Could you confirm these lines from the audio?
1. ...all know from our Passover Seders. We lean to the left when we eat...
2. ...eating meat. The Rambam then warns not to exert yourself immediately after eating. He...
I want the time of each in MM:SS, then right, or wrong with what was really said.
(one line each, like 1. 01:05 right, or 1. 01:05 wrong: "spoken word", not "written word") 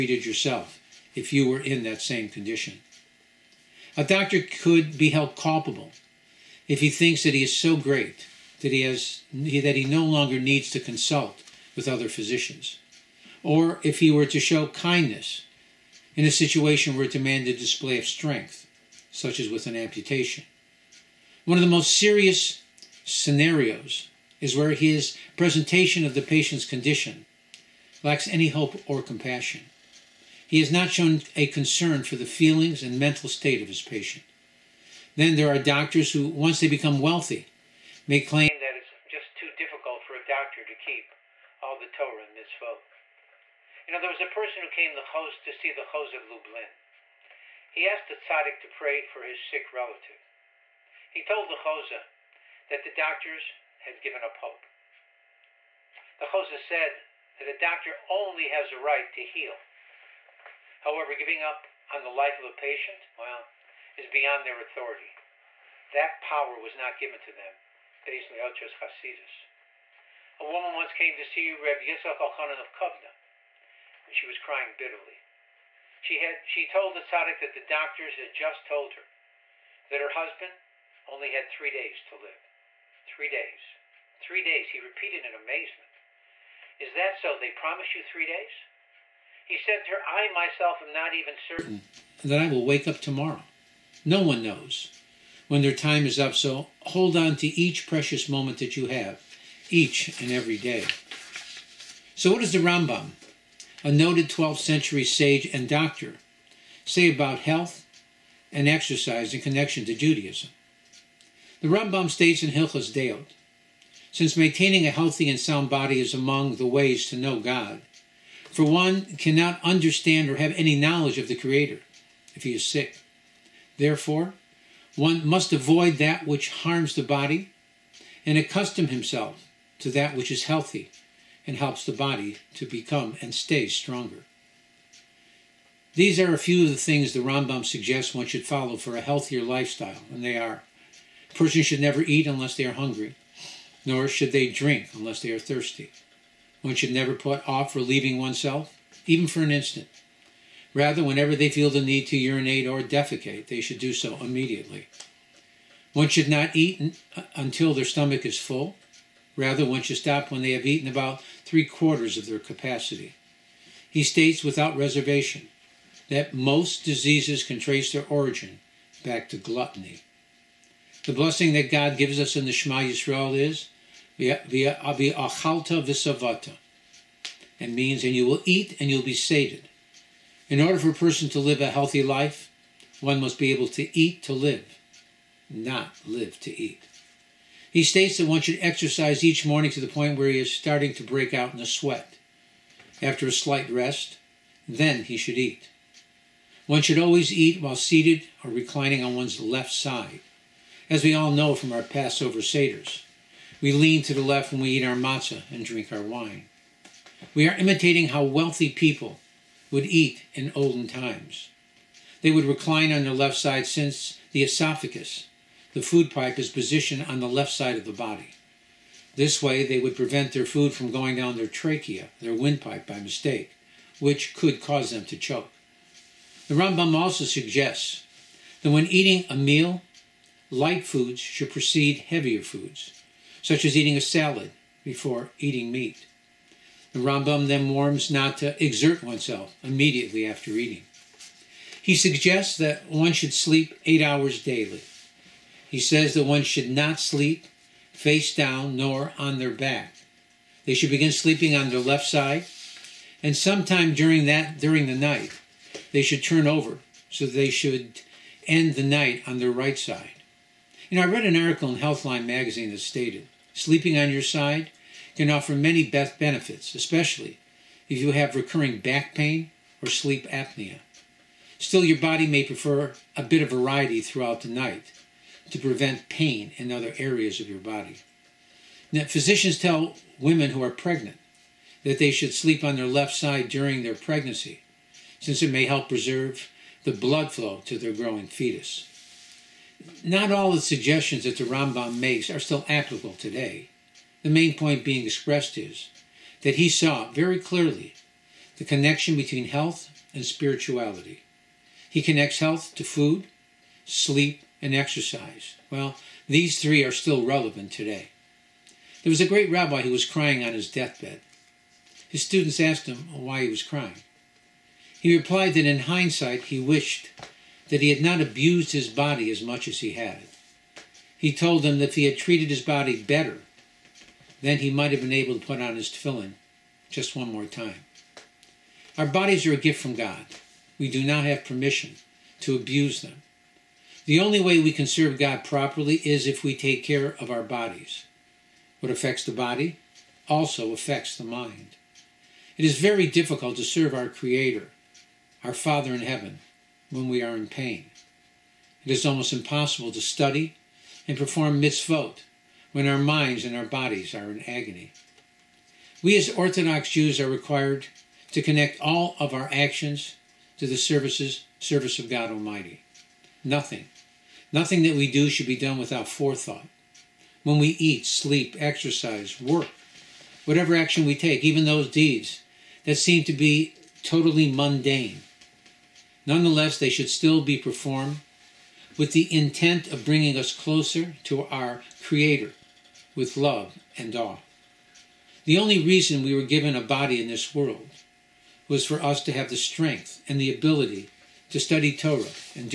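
1. 03:21 right
2. 03:55 wrong: "oneself", not "yourself".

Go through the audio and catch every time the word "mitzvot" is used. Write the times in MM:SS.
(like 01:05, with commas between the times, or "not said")
00:42, 05:51.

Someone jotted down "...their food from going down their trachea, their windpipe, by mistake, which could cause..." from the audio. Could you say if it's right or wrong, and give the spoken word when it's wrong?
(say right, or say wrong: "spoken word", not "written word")
right.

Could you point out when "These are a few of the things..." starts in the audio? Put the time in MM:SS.
02:15.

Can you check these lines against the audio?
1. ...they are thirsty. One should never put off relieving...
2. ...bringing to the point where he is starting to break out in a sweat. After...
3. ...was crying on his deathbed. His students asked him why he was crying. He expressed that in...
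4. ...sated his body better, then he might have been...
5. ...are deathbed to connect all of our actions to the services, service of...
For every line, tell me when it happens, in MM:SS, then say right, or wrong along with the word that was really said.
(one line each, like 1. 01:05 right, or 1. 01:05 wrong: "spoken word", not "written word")
1. 02:25 right
2. 03:09 wrong: "morning", not "bringing"
3. 05:09 wrong: "replied", not "expressed"
4. 05:22 wrong: "treated", not "sated"
5. 05:57 wrong: "required", not "deathbed".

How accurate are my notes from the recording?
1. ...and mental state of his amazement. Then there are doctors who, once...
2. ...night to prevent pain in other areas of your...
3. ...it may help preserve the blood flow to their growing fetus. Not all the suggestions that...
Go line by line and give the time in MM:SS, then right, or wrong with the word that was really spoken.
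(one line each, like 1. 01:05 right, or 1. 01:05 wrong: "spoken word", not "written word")
1. 00:32 wrong: "patient", not "amazement"
2. 04:34 right
3. 04:45 right.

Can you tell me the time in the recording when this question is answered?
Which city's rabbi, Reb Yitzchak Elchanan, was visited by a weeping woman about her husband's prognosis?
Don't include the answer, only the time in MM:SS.
01:12.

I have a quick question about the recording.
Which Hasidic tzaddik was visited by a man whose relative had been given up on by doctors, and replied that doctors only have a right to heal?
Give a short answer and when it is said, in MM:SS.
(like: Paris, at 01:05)
Chozeh of Lublin, at 00:45.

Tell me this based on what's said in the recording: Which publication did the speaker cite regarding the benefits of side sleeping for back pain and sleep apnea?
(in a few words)
Healthline.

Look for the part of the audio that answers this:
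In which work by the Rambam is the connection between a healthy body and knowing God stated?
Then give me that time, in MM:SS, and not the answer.
01:52.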